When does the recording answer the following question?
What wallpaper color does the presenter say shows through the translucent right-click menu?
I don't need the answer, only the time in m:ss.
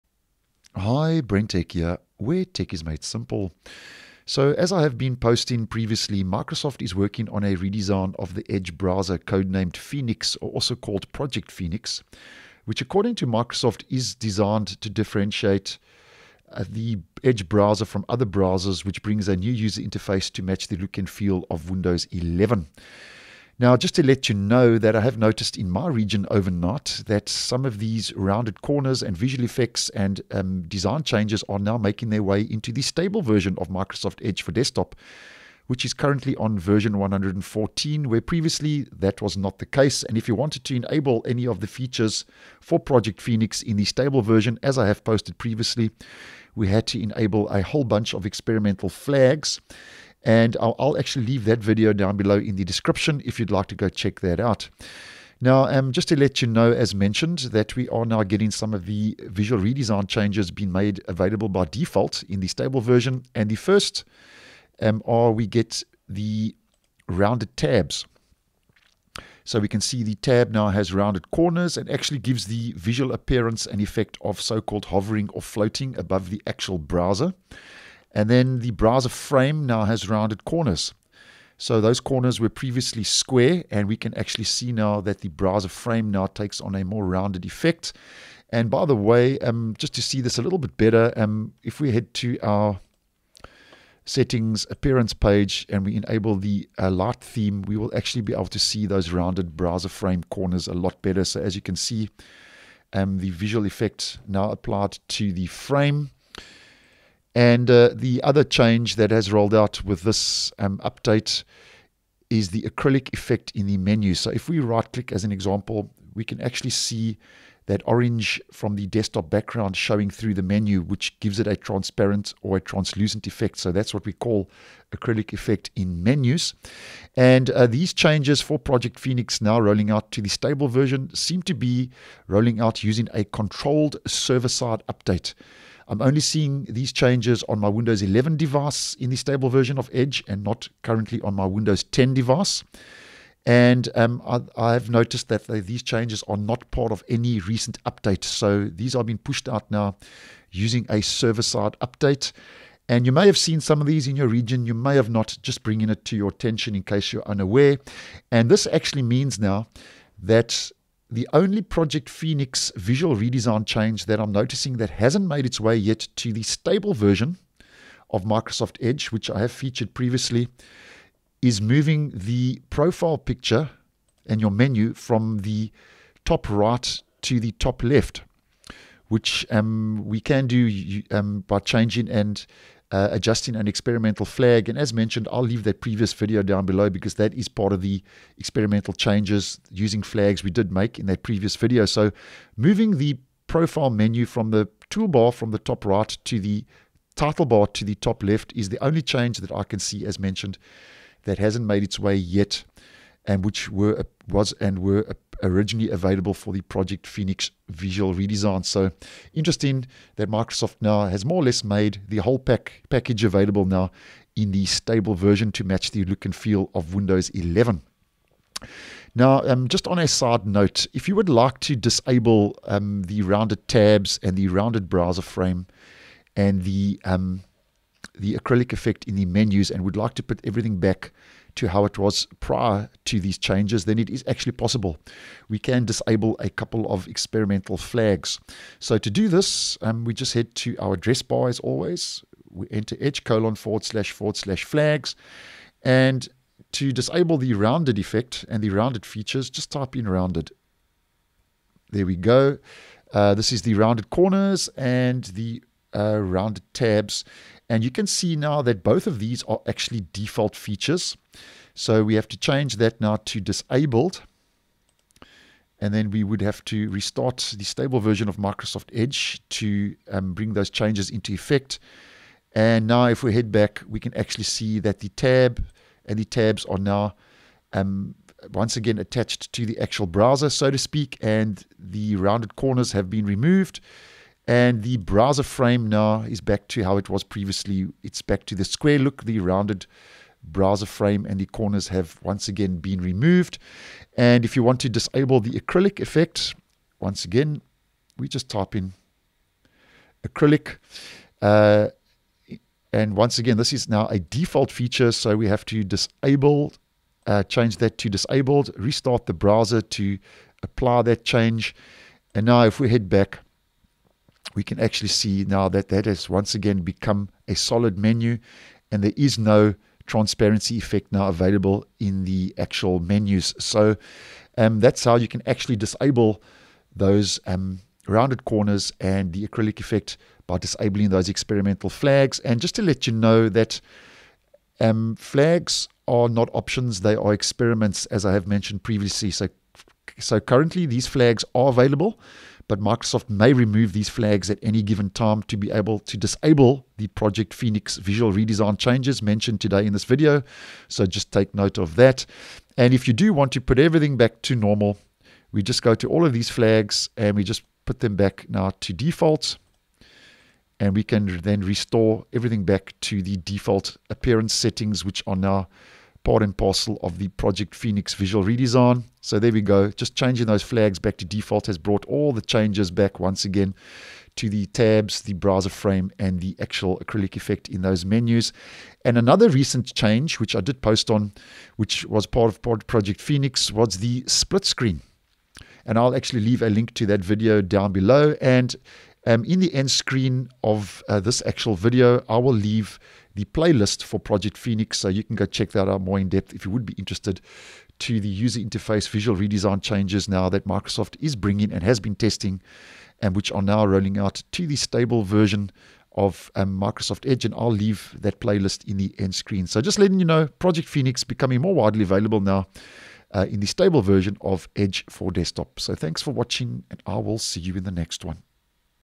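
1:57.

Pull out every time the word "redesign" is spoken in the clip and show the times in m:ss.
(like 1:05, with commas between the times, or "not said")
0:07, 0:59, 2:43, 3:28, 5:48, 6:08, 6:39.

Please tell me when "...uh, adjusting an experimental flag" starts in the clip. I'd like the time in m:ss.
3:02.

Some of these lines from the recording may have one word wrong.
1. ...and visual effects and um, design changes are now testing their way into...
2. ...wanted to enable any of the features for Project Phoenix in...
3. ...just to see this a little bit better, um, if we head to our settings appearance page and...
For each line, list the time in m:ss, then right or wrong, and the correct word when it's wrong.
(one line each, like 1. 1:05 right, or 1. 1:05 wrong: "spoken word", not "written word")
1. 0:29 wrong: "making", not "testing"
2. 0:40 right
3. 1:29 right.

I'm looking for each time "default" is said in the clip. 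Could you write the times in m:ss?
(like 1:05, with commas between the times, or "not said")
1:01, 4:20, 5:04, 5:58, 6:03, 6:11.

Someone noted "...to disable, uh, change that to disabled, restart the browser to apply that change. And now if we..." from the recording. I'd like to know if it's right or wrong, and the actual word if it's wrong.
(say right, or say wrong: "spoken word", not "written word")
right.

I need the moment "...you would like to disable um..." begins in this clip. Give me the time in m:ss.
3:41.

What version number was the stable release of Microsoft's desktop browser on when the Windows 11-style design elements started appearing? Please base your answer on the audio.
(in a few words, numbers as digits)
114.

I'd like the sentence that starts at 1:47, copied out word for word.
And uh, the other change that has rolled out with this um, update is the acrylic effect in the menu.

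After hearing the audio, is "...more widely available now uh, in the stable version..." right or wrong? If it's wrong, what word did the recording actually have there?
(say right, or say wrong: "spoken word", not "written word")
right.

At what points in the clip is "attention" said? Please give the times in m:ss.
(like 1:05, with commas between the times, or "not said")
2:36.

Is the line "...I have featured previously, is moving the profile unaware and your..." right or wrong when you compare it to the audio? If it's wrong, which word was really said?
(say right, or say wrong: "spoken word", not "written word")
wrong: "picture", not "unaware".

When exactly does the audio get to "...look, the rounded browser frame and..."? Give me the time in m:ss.
4:48.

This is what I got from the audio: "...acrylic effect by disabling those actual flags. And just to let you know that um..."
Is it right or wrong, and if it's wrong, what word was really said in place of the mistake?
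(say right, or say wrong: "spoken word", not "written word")
wrong: "experimental", not "actual".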